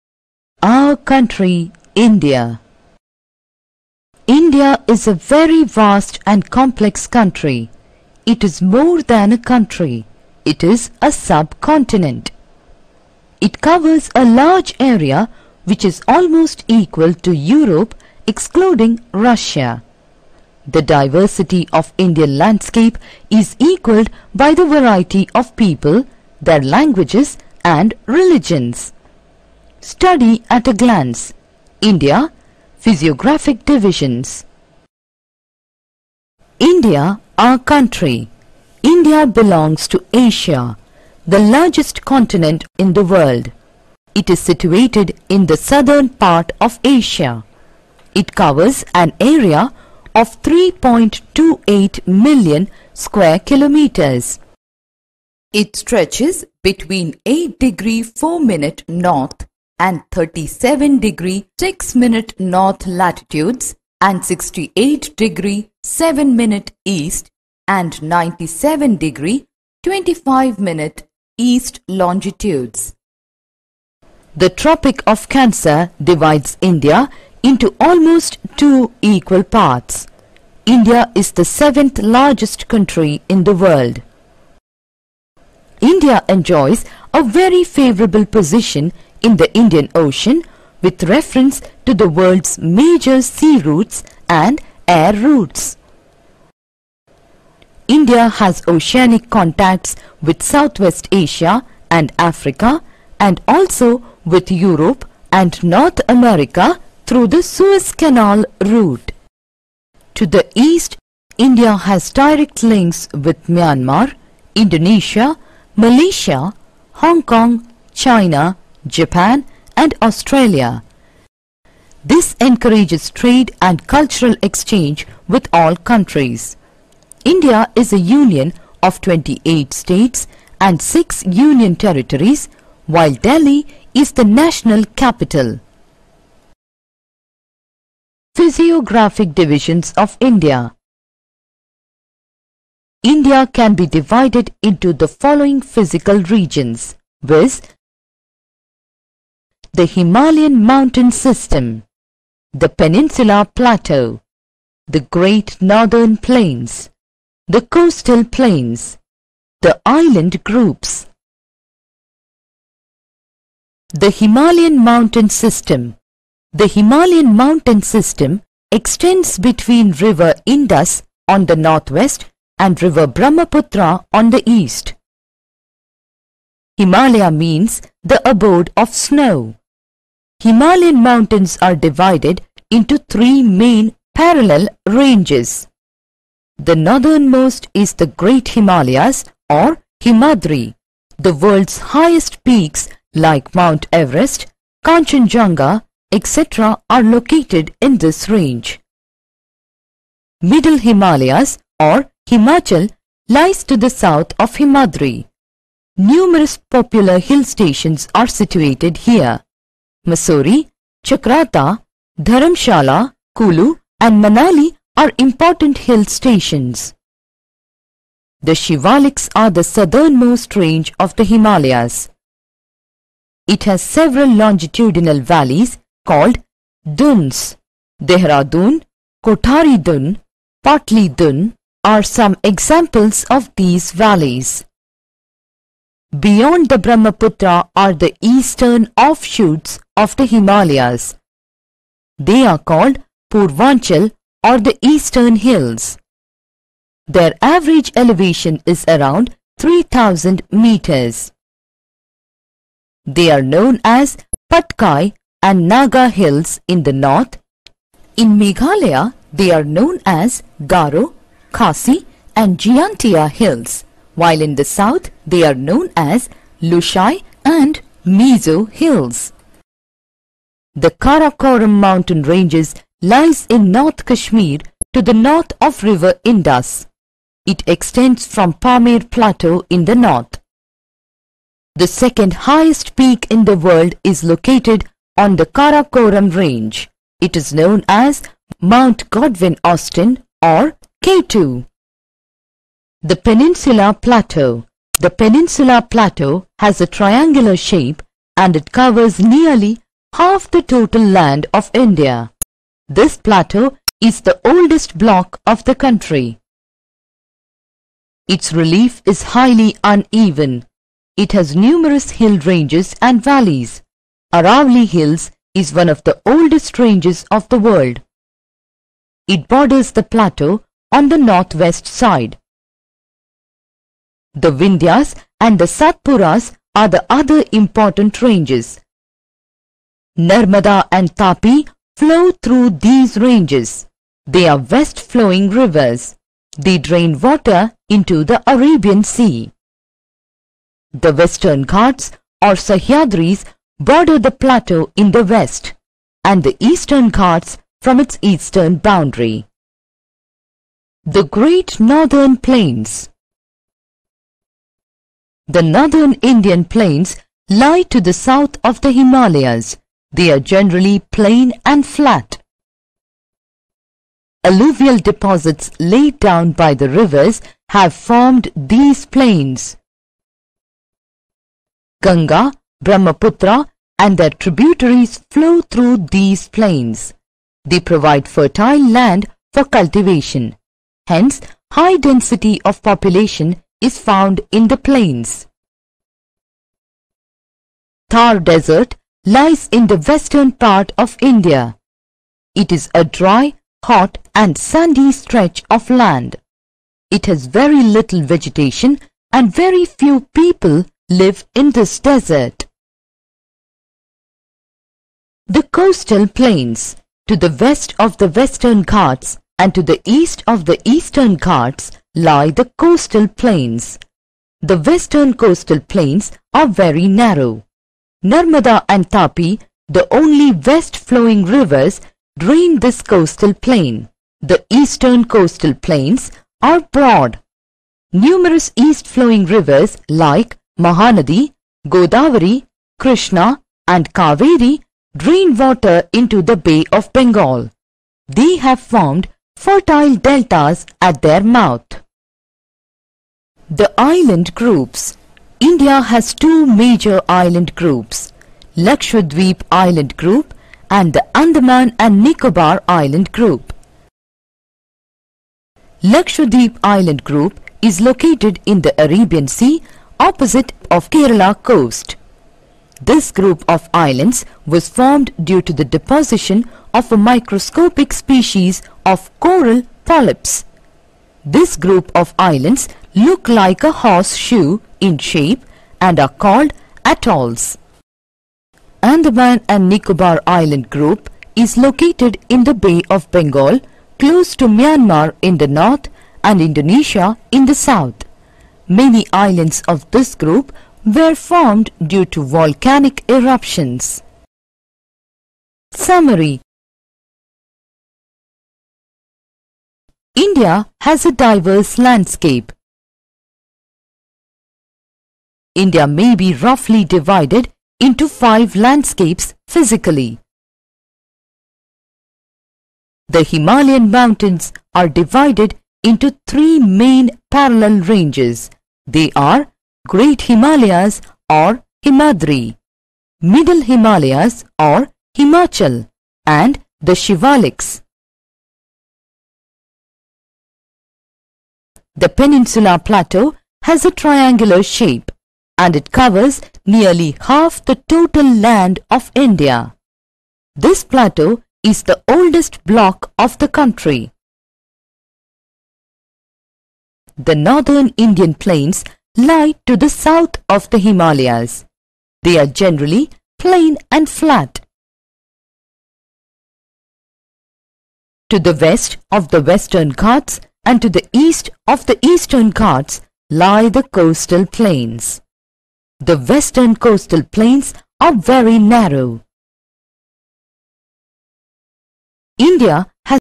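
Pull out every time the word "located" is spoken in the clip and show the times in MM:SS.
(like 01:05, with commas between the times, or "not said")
03:17, 04:44, 07:38, 08:01.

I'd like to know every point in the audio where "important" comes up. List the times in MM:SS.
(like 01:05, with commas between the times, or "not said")
03:35, 05:27.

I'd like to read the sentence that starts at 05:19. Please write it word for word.
It borders the plateau on the northwest side.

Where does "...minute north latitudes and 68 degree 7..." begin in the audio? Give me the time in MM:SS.
01:02.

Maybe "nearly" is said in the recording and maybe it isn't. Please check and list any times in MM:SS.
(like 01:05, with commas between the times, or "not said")
04:59, 08:56.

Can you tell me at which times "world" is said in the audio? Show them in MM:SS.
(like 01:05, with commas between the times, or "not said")
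00:43, 01:23, 01:32, 03:11, 04:43, 05:17.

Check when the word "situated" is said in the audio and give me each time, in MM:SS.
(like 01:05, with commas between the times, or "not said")
00:44, 03:28.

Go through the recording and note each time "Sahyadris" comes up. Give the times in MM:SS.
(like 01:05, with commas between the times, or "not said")
05:42.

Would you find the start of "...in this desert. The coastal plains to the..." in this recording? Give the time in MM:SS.
06:41.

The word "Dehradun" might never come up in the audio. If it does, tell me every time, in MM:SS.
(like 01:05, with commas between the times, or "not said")
03:48.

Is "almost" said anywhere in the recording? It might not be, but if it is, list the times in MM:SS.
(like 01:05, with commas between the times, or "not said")
00:16, 01:17.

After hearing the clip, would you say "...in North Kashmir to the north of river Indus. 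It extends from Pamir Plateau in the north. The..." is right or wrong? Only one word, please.
right.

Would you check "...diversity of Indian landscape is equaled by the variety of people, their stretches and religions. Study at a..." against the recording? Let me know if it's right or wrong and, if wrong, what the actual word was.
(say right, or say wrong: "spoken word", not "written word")
wrong: "languages", not "stretches".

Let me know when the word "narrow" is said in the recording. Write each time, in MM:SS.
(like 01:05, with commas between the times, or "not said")
06:57, 09:28.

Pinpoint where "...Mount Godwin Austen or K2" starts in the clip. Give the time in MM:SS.
04:48.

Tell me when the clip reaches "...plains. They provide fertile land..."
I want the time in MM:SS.
06:16.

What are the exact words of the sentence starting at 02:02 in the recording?
This encourages trade and cultural exchange with all countries.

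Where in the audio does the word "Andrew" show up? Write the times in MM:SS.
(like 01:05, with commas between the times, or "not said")
not said.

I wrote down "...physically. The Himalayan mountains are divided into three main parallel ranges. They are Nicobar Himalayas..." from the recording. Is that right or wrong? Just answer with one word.
wrong.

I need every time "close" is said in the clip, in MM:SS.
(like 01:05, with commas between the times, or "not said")
08:04.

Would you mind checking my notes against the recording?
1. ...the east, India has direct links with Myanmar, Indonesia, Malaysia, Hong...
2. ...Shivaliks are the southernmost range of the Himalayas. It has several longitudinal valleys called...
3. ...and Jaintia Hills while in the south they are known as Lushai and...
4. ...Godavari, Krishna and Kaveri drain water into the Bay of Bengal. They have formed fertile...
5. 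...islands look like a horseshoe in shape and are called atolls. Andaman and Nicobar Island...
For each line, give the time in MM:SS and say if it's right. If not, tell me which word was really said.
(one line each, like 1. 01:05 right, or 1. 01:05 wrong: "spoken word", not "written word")
1. 01:50 right
2. 03:38 right
3. 04:22 right
4. 07:11 right
5. 07:52 right.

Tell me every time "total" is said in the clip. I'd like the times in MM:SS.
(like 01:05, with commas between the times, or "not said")
05:00, 08:58.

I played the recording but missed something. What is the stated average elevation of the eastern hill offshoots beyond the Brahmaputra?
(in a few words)
3000 meters.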